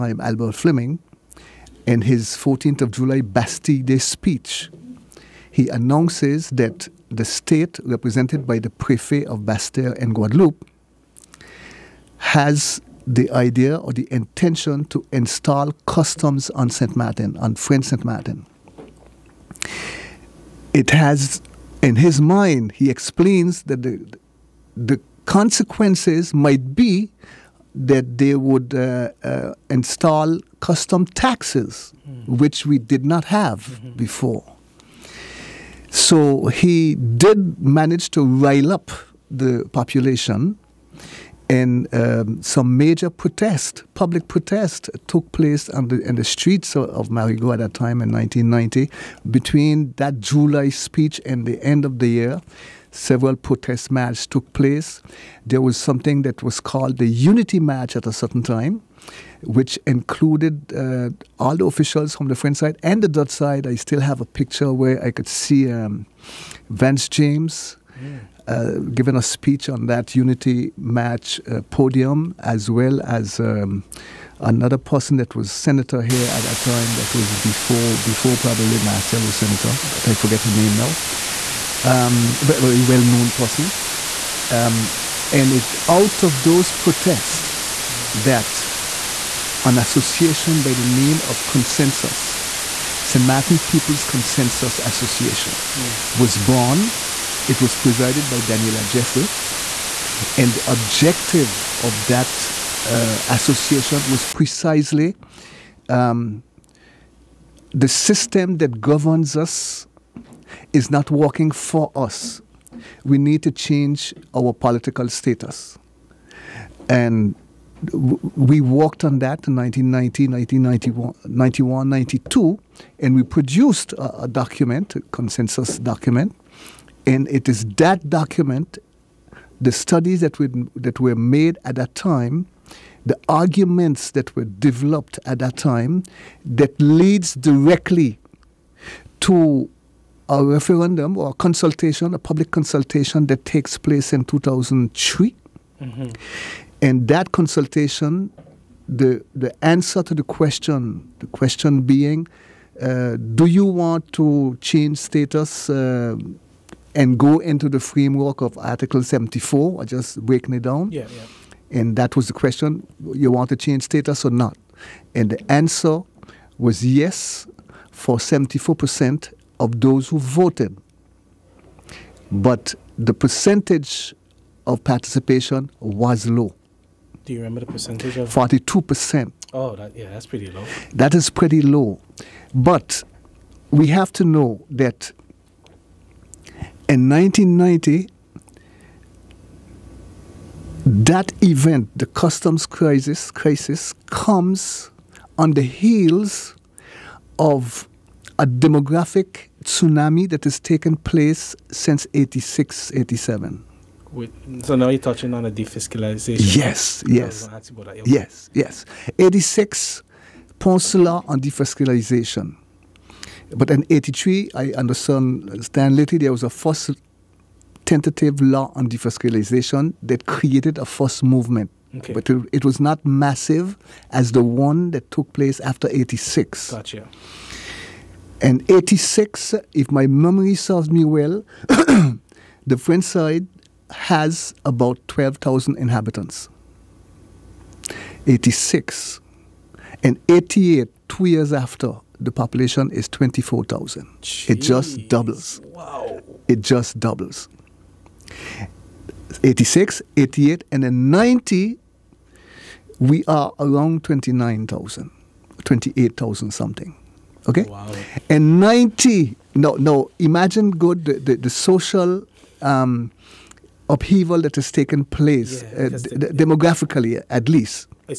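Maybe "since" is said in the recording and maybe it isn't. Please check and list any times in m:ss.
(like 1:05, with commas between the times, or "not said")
3:21.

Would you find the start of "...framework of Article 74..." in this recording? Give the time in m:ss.
2:37.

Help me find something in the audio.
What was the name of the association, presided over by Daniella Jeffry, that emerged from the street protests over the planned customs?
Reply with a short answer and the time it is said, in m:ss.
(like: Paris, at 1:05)
St. Martin People's Consensus Association, at 1:33.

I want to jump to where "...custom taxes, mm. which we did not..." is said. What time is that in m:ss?
0:30.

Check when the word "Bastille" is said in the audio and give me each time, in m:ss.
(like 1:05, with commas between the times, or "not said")
0:03, 0:09.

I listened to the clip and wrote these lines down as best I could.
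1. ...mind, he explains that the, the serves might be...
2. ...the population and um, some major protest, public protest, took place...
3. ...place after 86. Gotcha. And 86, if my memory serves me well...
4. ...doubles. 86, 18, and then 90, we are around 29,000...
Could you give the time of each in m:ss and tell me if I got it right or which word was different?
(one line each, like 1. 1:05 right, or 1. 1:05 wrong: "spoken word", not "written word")
1. 0:22 wrong: "consequences", not "serves"
2. 0:39 right
3. 3:45 right
4. 4:06 wrong: "88", not "18".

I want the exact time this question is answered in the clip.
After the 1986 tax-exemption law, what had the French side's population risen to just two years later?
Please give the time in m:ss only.
4:03.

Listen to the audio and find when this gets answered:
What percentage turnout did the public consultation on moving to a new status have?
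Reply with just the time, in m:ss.
2:58.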